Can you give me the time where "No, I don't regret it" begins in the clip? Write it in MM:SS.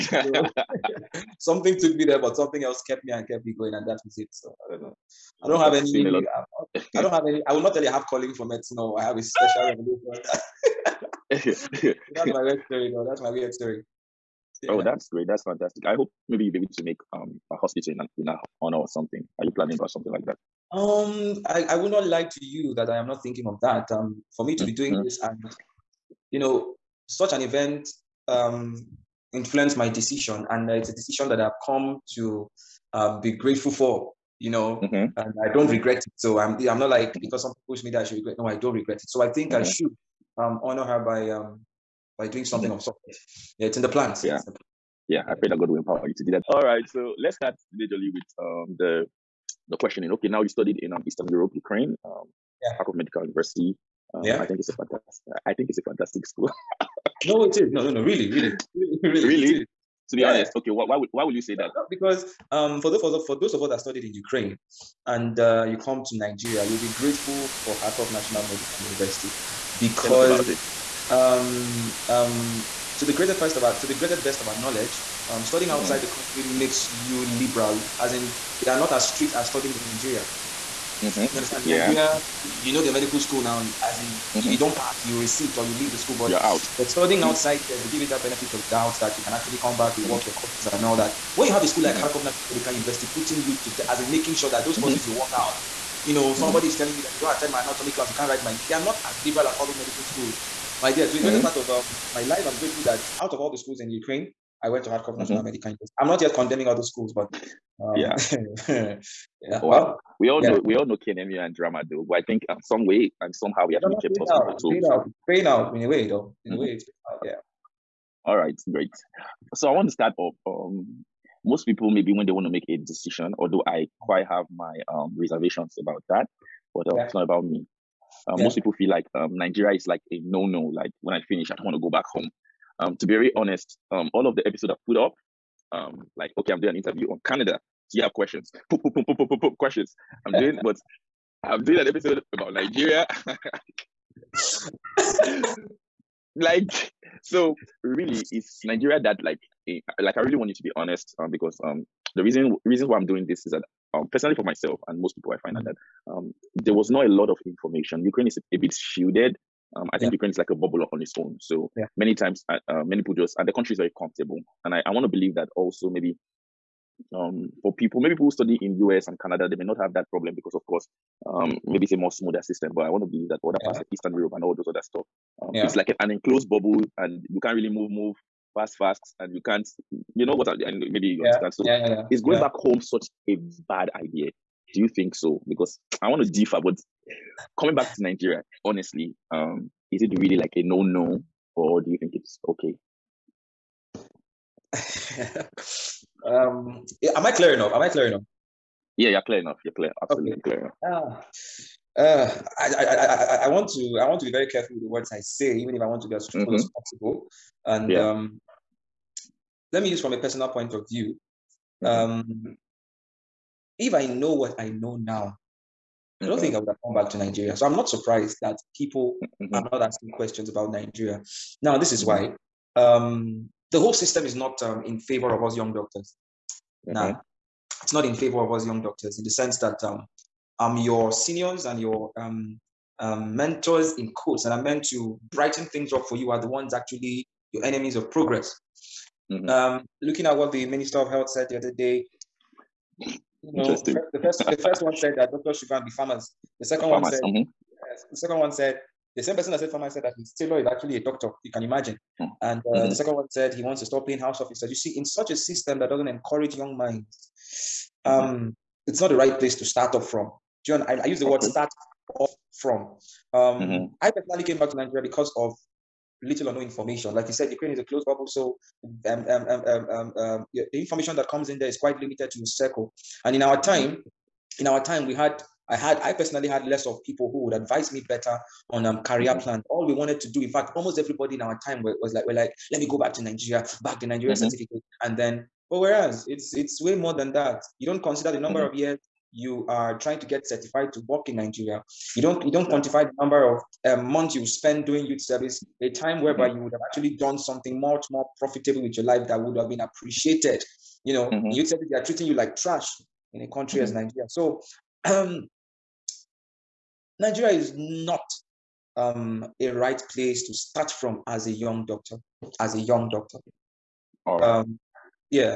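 00:38.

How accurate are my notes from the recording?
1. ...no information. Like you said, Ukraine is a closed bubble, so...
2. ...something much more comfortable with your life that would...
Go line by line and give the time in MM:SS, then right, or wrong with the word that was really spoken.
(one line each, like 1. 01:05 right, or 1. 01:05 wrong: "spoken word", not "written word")
1. 04:26 right
2. 04:57 wrong: "profitable", not "comfortable".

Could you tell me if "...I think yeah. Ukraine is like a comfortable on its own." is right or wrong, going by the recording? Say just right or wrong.
wrong.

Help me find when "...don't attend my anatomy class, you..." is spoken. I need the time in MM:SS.
01:37.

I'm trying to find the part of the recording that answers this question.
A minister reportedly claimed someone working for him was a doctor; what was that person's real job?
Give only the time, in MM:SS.
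04:10.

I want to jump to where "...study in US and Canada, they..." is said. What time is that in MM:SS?
02:48.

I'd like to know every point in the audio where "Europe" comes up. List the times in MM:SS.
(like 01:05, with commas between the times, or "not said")
00:51, 02:54.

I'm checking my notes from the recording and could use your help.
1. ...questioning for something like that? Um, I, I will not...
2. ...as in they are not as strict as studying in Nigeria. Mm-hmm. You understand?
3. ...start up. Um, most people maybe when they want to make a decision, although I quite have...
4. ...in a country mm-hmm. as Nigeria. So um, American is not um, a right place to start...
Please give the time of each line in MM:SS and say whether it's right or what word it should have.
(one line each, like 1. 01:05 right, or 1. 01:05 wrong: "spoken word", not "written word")
1. 00:19 wrong: "planning", not "questioning"
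2. 01:17 right
3. 01:59 right
4. 05:03 wrong: "Nigeria", not "American".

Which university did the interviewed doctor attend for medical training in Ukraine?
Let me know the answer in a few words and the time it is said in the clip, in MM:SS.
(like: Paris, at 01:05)
Kharkov Medical University, at 00:52.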